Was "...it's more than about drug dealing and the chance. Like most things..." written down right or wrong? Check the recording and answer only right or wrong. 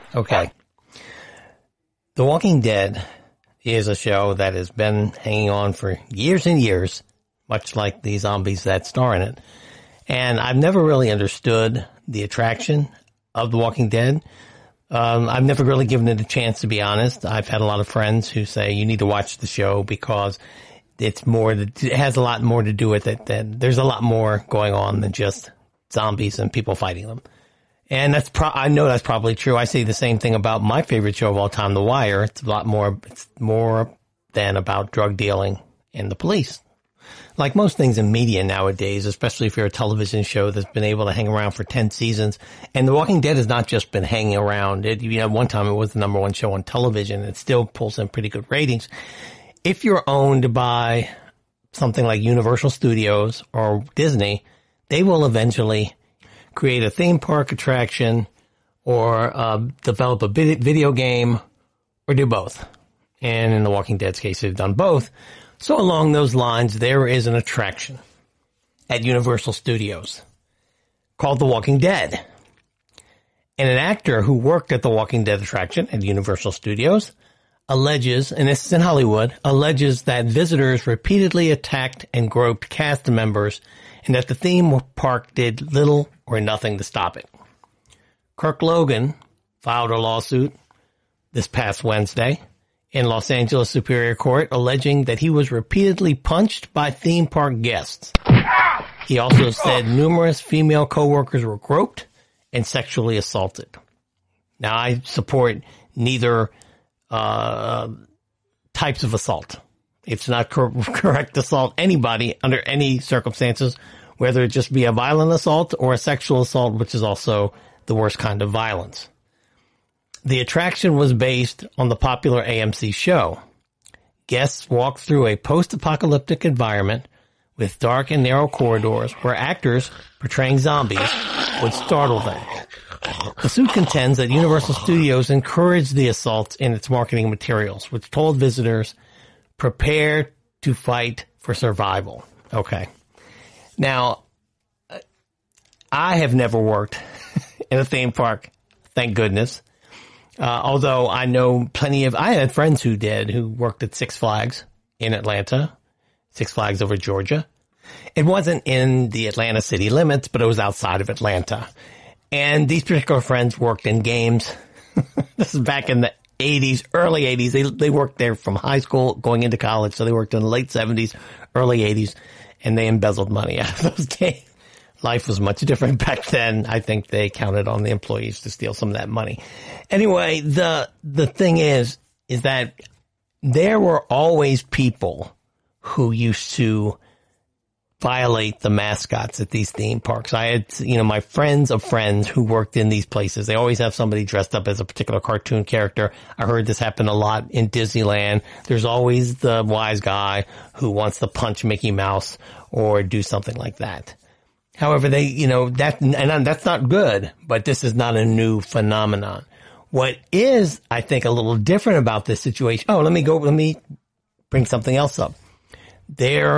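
wrong.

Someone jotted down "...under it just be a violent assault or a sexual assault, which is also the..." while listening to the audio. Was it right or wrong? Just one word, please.
wrong.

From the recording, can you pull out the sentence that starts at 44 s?
It, you know, one time it was the number one show on television.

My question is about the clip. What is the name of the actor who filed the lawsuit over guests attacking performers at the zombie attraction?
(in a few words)
Kirk Logan.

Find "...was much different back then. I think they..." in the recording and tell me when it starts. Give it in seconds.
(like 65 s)
175 s.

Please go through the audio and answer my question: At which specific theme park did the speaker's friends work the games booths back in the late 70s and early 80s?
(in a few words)
Six Flags over Georgia.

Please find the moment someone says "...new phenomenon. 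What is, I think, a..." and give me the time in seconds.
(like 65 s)
208 s.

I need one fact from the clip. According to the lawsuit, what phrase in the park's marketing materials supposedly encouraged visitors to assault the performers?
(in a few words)
Prepare to fight for survival.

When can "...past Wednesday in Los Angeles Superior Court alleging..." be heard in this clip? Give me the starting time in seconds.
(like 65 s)
91 s.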